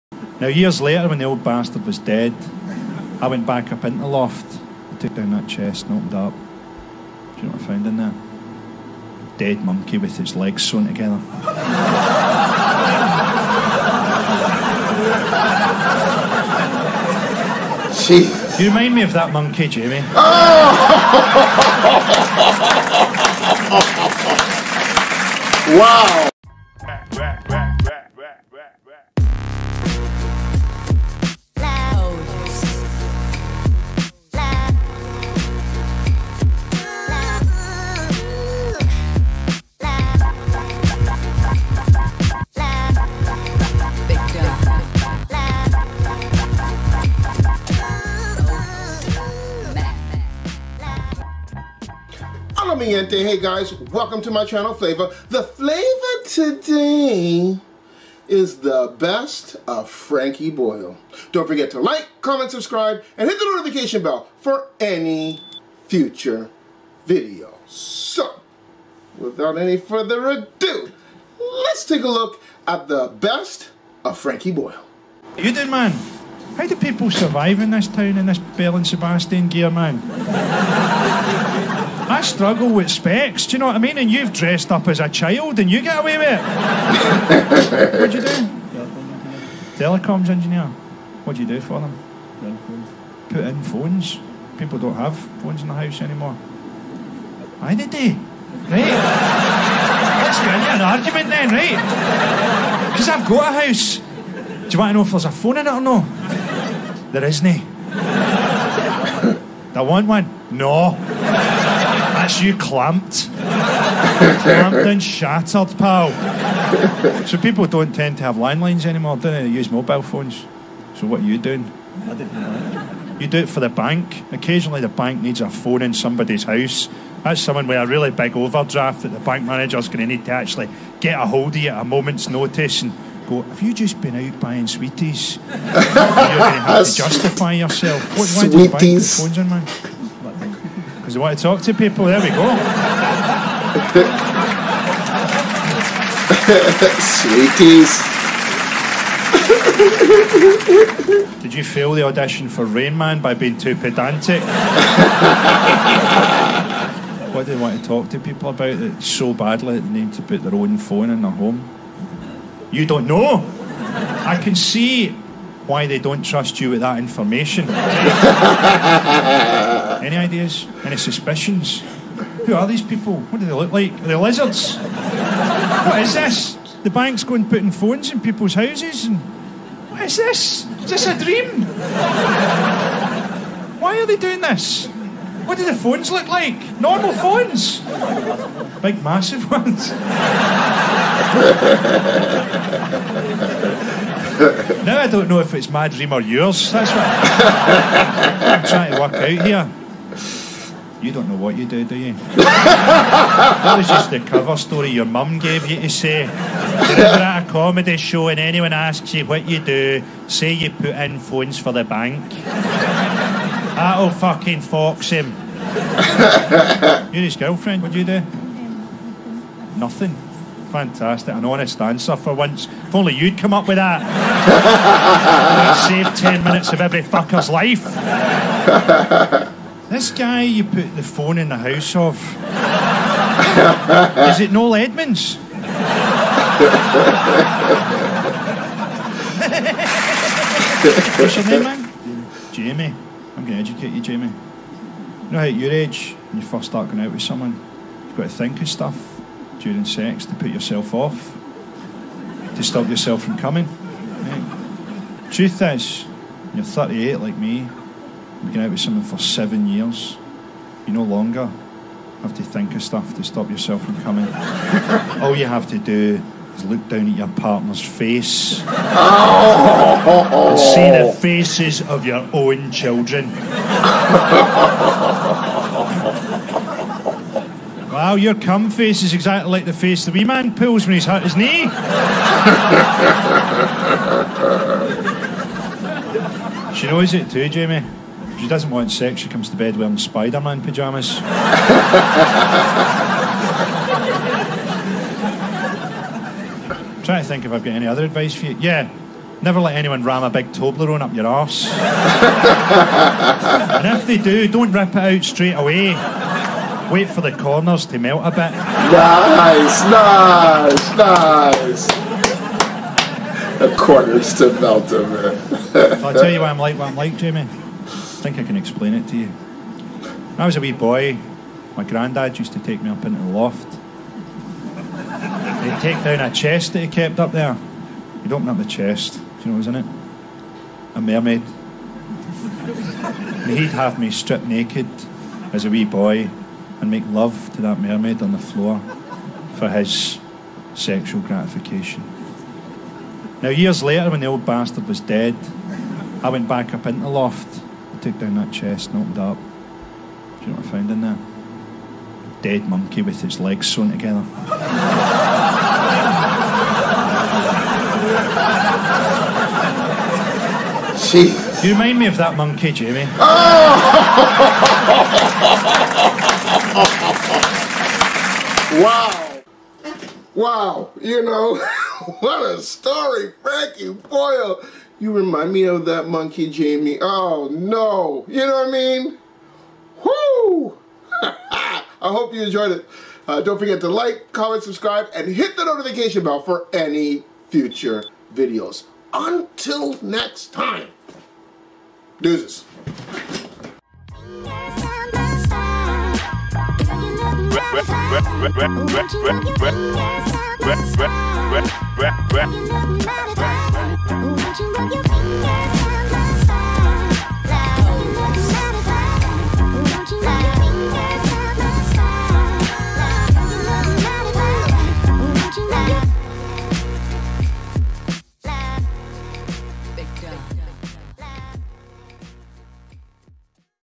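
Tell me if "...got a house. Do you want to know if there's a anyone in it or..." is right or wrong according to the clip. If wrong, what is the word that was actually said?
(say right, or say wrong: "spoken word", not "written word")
wrong: "phone", not "anyone".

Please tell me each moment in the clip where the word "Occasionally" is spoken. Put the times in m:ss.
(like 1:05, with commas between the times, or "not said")
2:04.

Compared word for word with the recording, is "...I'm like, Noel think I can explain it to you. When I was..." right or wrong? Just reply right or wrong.
wrong.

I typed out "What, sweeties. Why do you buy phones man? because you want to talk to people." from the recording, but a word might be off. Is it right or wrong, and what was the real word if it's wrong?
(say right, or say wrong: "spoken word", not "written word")
right.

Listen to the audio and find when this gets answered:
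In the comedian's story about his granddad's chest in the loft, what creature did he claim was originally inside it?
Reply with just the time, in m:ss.
5:30.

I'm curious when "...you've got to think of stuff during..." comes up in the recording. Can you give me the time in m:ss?
4:08.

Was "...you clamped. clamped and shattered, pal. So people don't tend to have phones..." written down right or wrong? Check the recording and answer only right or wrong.
wrong.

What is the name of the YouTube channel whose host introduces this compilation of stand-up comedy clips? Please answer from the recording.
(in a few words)
Phlava.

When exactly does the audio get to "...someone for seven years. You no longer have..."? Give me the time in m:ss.
4:18.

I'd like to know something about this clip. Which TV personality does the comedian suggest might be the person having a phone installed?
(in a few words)
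Noel Edmonds.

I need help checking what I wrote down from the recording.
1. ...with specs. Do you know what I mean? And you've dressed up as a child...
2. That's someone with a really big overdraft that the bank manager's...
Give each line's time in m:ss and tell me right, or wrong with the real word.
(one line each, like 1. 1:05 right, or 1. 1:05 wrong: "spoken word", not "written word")
1. 1:22 right
2. 2:07 right.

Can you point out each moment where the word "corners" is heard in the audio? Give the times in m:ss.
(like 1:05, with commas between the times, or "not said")
5:07, 5:13.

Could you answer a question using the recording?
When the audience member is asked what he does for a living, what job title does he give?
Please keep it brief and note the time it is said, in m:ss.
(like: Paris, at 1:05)
Telecoms engineer, at 1:29.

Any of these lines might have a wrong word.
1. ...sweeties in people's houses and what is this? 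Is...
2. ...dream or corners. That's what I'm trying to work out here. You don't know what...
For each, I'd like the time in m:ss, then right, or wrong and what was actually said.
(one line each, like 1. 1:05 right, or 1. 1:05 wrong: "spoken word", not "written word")
1. 2:57 wrong: "phones", not "sweeties"
2. 3:15 wrong: "yours", not "corners".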